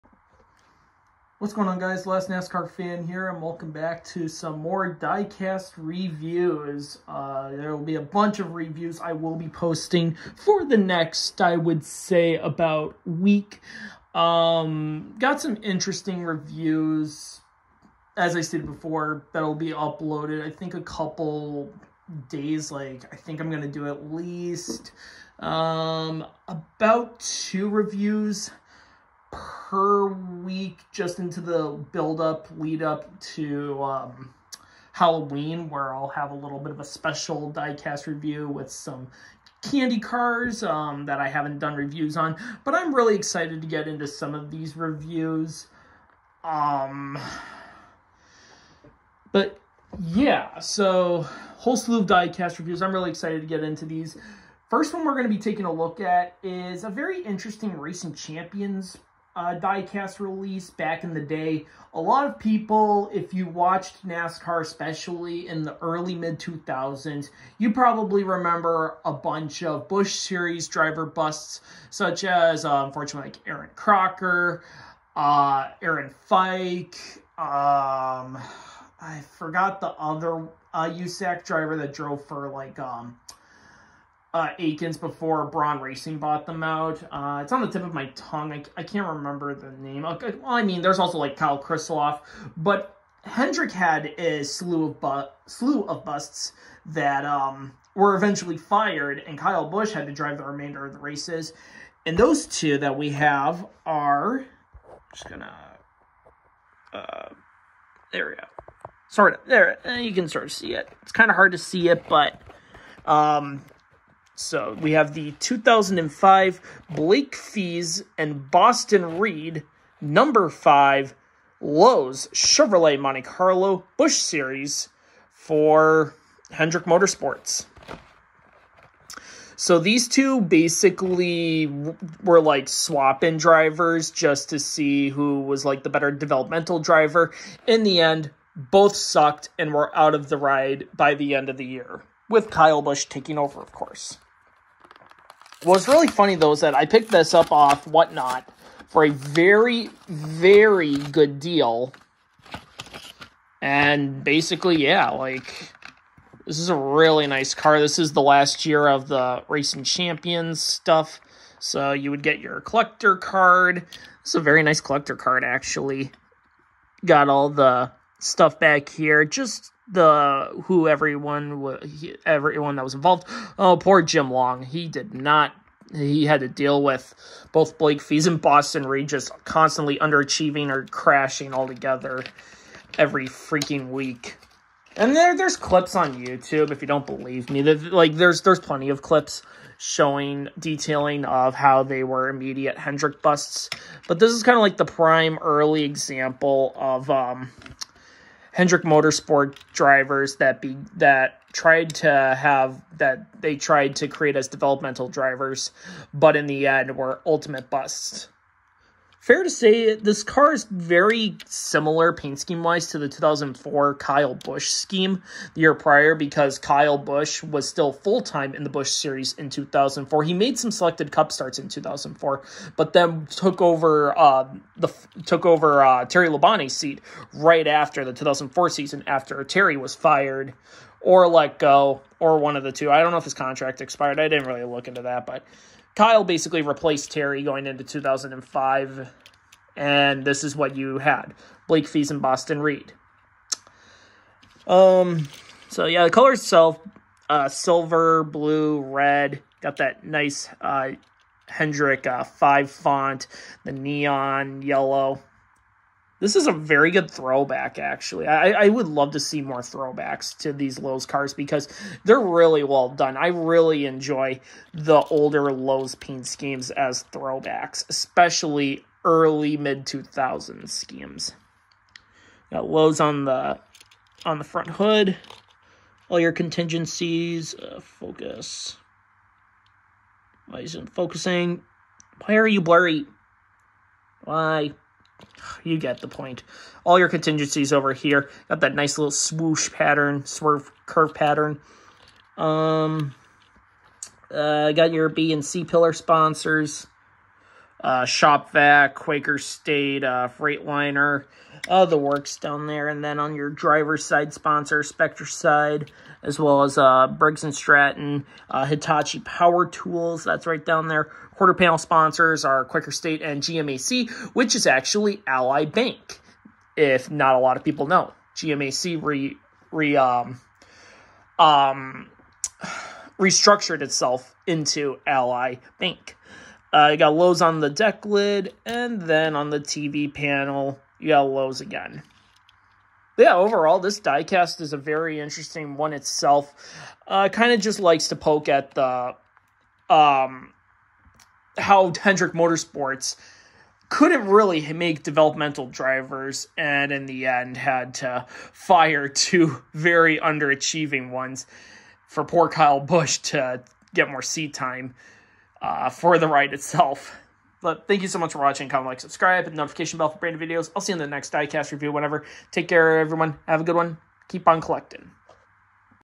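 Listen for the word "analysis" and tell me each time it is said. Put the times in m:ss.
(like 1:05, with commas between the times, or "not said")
not said.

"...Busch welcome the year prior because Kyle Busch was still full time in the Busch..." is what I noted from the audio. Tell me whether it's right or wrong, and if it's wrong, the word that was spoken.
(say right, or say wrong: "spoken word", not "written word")
wrong: "scheme", not "welcome".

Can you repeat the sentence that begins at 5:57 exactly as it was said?
But thank you so much for watching.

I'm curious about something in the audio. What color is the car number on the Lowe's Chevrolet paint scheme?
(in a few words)
neon yellow.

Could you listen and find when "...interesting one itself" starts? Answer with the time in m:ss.
5:35.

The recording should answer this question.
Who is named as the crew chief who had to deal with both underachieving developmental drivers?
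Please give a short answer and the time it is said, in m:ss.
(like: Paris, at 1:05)
Jim Long, at 2:54.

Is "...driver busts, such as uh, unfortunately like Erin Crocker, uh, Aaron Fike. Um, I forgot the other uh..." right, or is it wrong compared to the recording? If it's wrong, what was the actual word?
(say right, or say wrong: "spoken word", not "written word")
right.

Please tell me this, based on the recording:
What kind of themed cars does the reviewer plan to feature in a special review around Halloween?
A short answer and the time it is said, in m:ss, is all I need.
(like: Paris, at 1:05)
candy cars, at 0:39.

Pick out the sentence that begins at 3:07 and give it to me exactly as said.
That like there's there's plenty of clips showing detailing of how they were immediate Hendrick busts.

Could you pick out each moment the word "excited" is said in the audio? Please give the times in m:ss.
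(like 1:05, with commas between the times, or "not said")
0:43, 0:53.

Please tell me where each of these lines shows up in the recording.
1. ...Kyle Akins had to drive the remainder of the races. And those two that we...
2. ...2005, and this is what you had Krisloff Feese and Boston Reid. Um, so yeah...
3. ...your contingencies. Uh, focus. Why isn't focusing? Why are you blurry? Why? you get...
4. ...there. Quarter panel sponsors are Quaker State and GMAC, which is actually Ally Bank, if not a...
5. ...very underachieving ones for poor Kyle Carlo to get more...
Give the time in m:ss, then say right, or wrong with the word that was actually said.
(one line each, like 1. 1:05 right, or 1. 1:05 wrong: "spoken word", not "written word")
1. 1:39 wrong: "Busch", not "Akins"
2. 3:57 wrong: "Blake", not "Krisloff"
3. 4:36 right
4. 5:10 right
5. 5:49 wrong: "Busch", not "Carlo".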